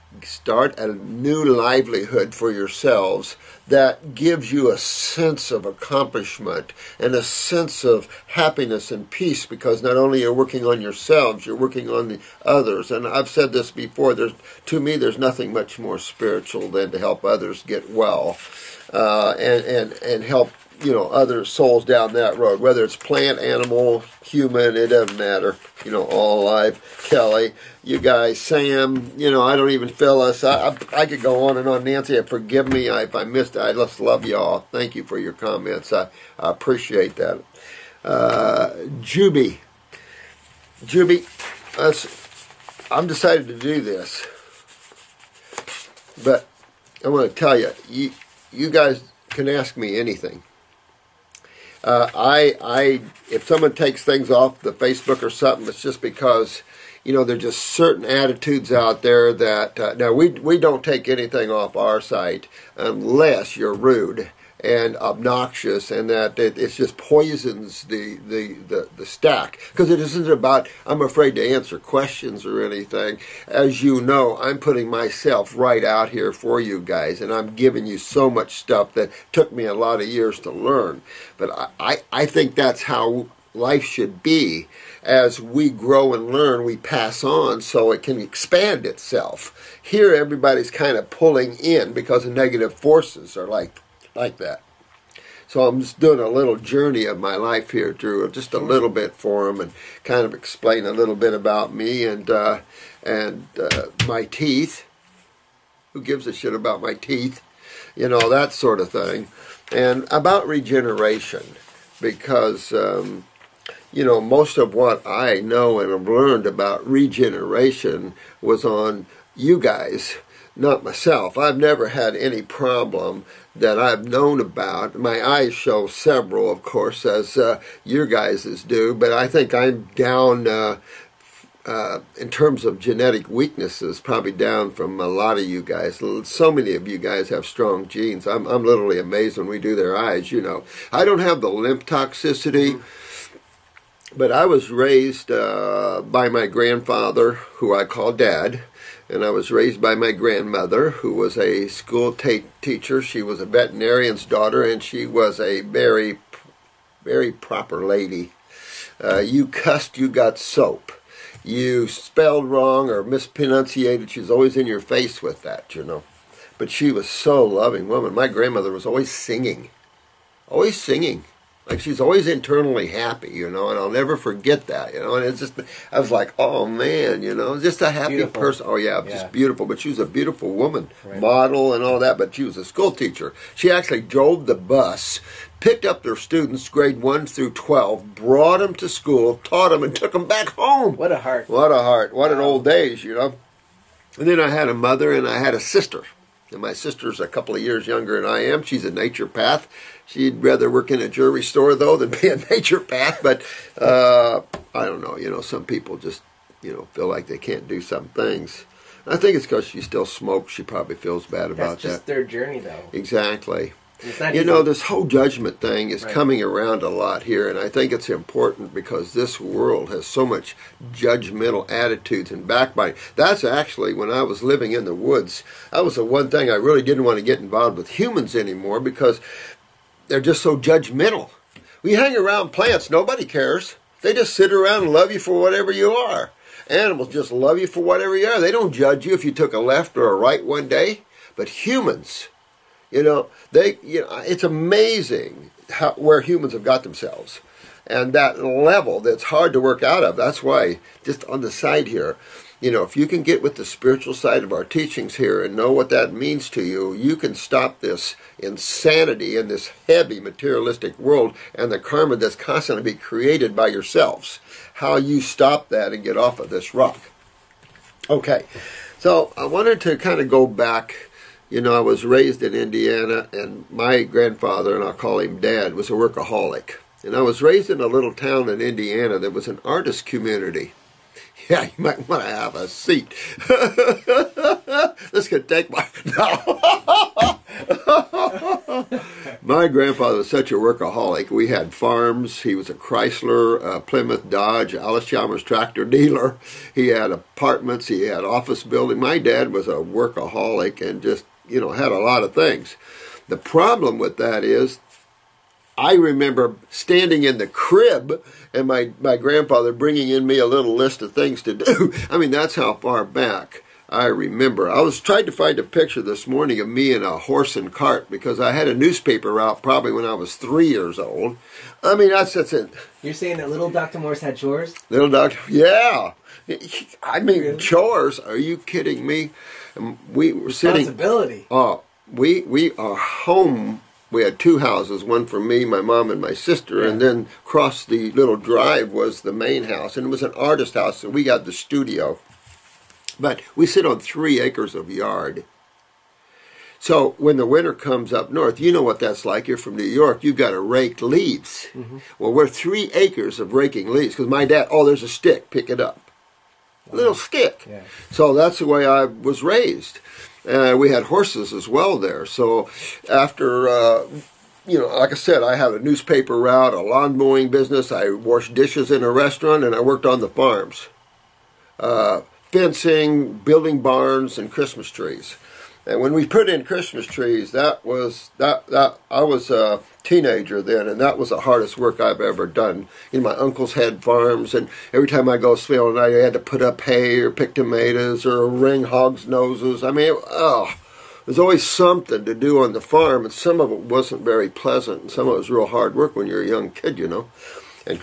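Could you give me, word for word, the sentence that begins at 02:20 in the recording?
I don't have the lymph toxicity.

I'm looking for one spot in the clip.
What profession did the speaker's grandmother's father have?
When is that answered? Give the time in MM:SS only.
02:33.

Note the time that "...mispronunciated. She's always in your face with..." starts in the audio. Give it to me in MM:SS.
02:43.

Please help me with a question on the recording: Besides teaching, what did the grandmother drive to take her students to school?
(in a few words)
The bus.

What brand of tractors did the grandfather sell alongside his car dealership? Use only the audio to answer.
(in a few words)
Allis Chalmers.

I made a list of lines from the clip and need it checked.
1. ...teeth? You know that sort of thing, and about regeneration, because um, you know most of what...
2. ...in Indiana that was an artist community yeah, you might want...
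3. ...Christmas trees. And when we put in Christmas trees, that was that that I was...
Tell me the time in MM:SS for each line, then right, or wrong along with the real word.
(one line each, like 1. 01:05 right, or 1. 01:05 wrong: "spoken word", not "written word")
1. 01:46 right
2. 04:38 right
3. 06:14 right.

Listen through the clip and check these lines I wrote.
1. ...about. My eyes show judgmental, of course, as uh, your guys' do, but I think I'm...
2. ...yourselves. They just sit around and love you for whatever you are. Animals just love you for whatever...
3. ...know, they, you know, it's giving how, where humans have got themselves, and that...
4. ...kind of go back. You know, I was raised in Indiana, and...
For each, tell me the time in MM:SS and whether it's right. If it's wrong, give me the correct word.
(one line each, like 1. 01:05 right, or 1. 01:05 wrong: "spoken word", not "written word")
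1. 02:04 wrong: "several", not "judgmental"
2. 03:53 wrong: "cares", not "yourselves"
3. 04:03 wrong: "amazing", not "giving"
4. 04:29 right.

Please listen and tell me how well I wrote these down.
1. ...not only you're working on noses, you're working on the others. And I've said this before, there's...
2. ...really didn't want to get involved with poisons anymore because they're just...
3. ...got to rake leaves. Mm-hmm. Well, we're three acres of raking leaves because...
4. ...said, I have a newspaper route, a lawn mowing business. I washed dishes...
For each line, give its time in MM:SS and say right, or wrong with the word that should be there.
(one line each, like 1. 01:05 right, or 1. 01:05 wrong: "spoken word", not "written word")
1. 00:09 wrong: "yourselves", not "noses"
2. 03:46 wrong: "humans", not "poisons"
3. 05:50 right
4. 06:05 right.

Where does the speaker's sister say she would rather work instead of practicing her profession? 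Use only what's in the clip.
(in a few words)
A jewelry store.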